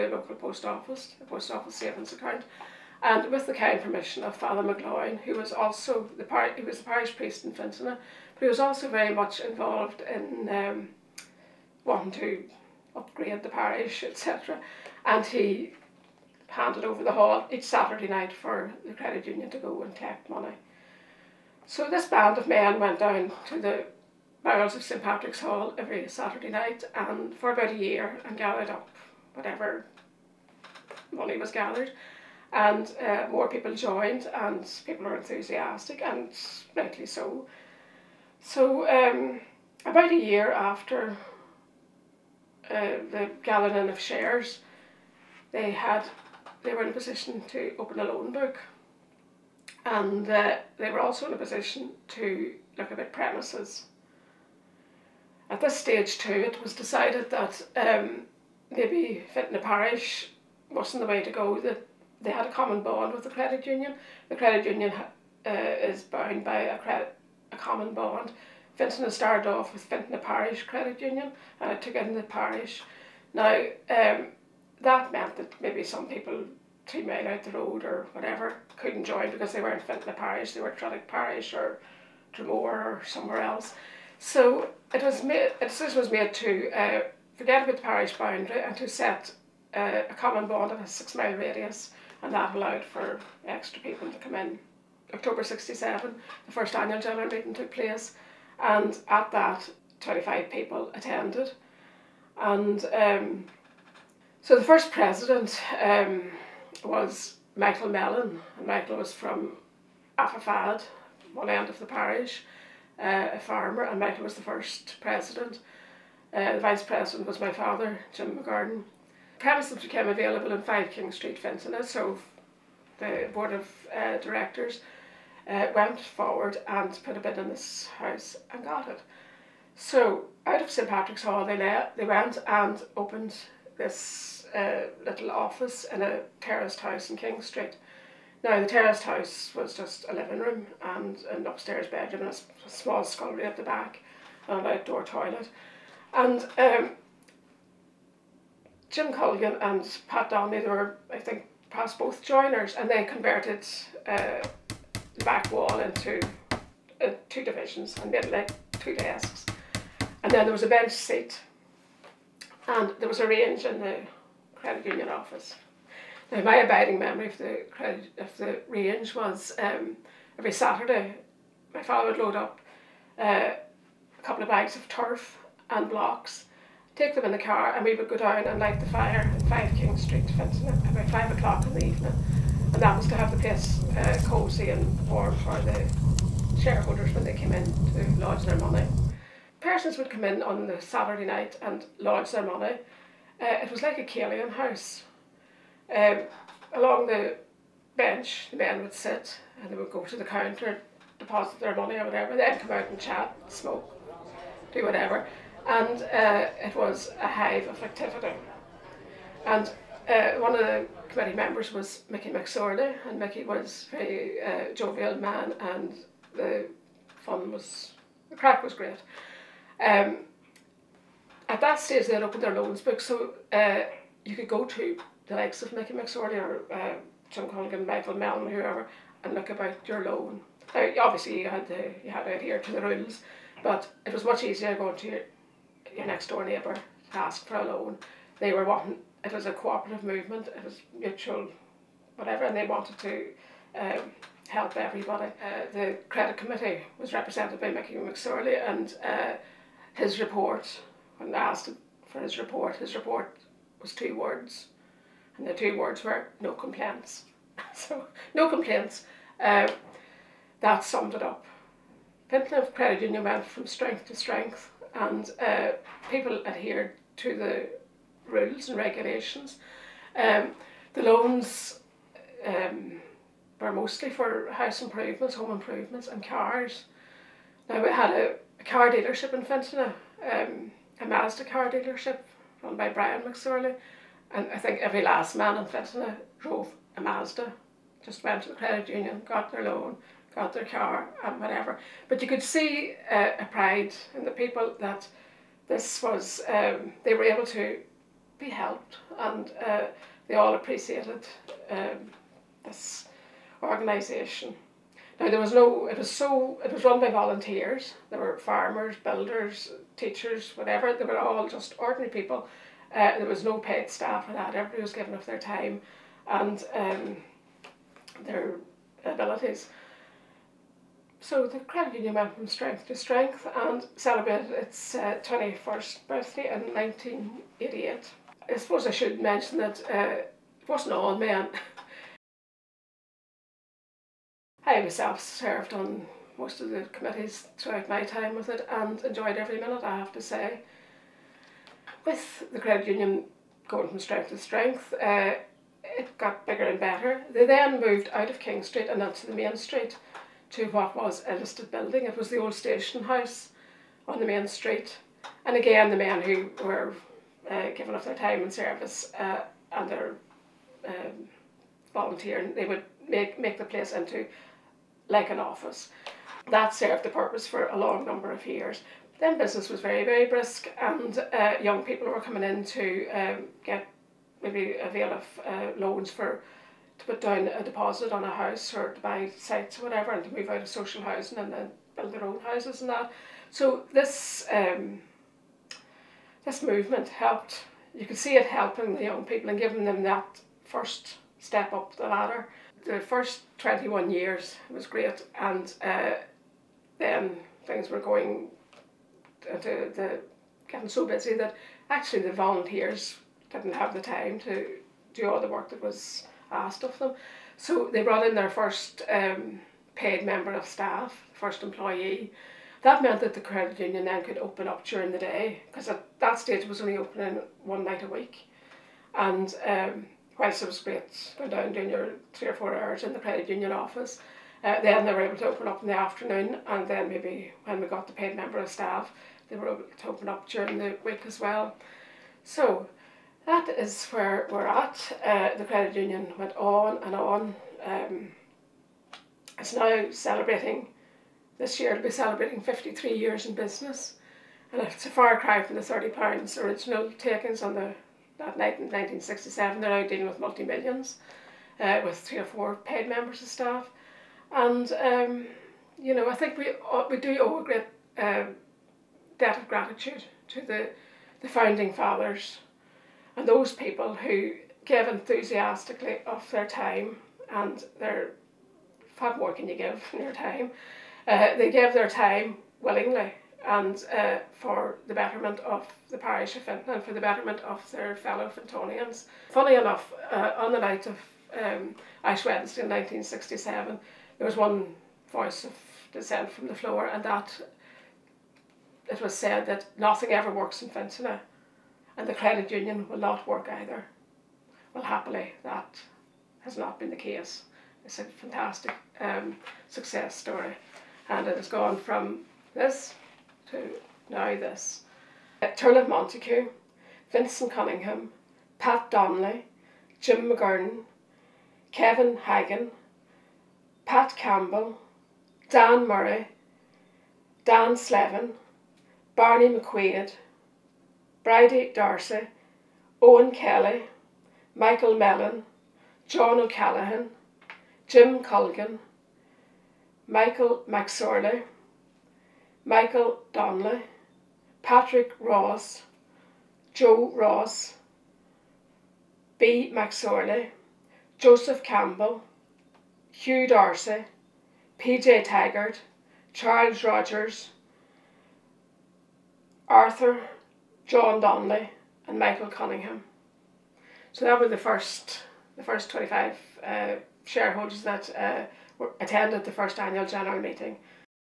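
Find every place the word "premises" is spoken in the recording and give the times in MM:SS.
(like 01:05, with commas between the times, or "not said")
00:53, 01:59.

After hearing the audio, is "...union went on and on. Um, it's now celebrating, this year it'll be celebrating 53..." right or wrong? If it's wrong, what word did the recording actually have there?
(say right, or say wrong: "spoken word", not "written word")
right.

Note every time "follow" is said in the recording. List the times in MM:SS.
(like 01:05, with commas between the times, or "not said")
not said.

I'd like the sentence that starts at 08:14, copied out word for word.
Well, happily, that has not been the case.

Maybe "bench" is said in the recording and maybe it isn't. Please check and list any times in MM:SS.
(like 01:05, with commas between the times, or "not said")
02:40, 03:17.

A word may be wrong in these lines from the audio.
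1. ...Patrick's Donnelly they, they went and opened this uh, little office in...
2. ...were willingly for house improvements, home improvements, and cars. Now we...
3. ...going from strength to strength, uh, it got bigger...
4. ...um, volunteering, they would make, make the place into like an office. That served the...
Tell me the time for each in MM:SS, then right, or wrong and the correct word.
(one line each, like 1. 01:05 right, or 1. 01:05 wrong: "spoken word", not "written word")
1. 02:10 wrong: "Hall", not "Donnelly"
2. 04:33 wrong: "mostly", not "willingly"
3. 05:43 right
4. 06:00 right.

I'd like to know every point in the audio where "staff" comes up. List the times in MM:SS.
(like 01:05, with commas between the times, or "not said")
05:13, 06:50, 07:08, 07:33.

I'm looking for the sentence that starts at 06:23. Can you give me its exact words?
So this um, this movement helped.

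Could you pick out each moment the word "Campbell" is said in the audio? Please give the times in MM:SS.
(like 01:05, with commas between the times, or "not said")
08:34, 09:01.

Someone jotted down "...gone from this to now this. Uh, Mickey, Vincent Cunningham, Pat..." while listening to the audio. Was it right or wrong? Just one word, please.
wrong.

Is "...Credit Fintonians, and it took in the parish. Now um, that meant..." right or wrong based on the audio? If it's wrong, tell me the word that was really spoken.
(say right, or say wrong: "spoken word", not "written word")
wrong: "Union", not "Fintonians".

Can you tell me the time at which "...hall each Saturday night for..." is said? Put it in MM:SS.
00:17.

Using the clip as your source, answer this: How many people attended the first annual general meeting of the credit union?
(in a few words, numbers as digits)
25.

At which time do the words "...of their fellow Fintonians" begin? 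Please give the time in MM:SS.
07:57.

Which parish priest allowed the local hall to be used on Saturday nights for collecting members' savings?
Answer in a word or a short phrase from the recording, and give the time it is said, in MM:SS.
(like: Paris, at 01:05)
Father McLaughlin, at 00:04.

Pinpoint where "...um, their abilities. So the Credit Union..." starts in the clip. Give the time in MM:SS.
05:16.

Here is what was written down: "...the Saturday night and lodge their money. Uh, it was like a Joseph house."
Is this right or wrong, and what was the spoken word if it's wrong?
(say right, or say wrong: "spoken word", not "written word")
wrong: "Kalian", not "Joseph".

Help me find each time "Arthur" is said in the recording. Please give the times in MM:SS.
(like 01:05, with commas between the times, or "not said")
09:09.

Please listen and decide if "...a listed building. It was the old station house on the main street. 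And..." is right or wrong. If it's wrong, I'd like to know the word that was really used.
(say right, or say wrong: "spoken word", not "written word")
right.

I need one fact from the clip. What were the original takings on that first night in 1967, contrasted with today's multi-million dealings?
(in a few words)
£30.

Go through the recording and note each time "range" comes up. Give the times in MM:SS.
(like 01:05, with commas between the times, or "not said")
02:43, 02:48.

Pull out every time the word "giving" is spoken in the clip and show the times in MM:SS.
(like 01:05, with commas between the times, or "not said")
05:14, 05:57, 06:29.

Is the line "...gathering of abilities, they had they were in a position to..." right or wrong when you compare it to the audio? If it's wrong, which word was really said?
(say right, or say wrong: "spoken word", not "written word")
wrong: "shares", not "abilities".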